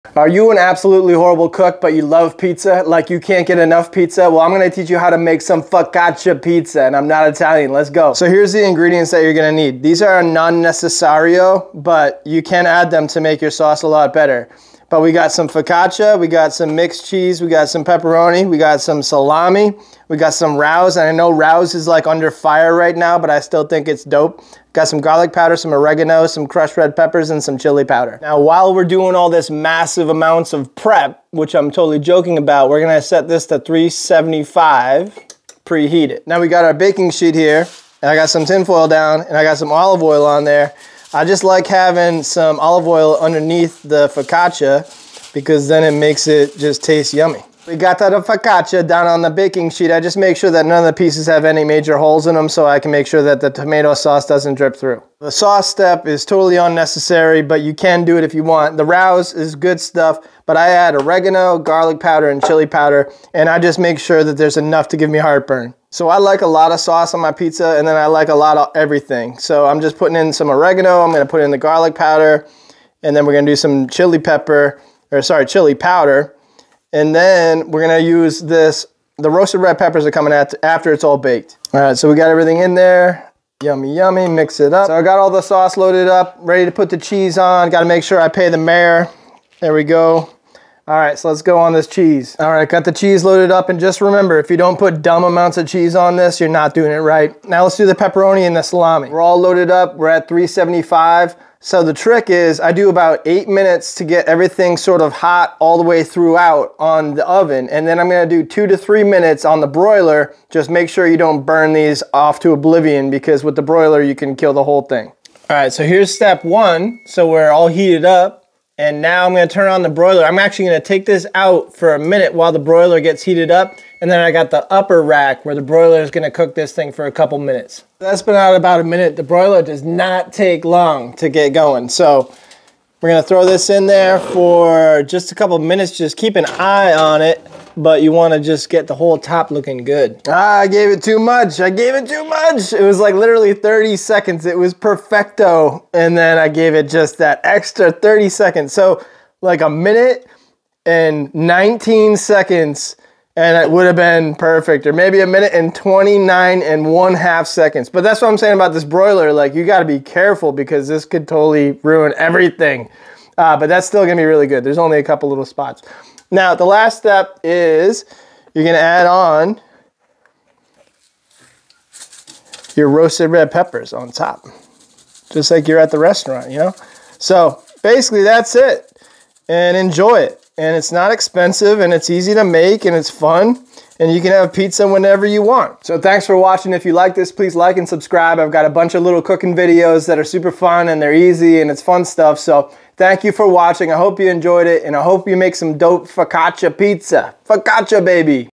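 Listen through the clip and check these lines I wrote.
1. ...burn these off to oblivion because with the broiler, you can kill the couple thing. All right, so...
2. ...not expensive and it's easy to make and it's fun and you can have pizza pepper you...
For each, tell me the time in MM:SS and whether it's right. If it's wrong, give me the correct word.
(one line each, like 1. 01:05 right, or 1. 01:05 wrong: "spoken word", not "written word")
1. 01:51 wrong: "whole", not "couple"
2. 03:00 wrong: "whenever", not "pepper".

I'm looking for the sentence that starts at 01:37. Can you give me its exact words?
Now let's do the pepperoni and the salami.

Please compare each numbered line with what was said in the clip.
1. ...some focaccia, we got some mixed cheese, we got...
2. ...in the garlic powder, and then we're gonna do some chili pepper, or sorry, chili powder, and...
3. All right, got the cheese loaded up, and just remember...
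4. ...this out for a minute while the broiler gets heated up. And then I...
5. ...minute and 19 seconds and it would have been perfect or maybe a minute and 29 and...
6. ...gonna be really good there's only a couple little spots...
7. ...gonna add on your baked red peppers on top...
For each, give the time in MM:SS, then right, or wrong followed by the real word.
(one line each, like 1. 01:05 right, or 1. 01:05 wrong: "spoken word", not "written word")
1. 00:15 right
2. 01:11 right
3. 01:32 right
4. 02:01 right
5. 02:29 right
6. 02:44 right
7. 02:48 wrong: "roasted", not "baked".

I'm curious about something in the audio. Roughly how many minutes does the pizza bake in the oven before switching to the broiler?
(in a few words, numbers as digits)
8 minutes.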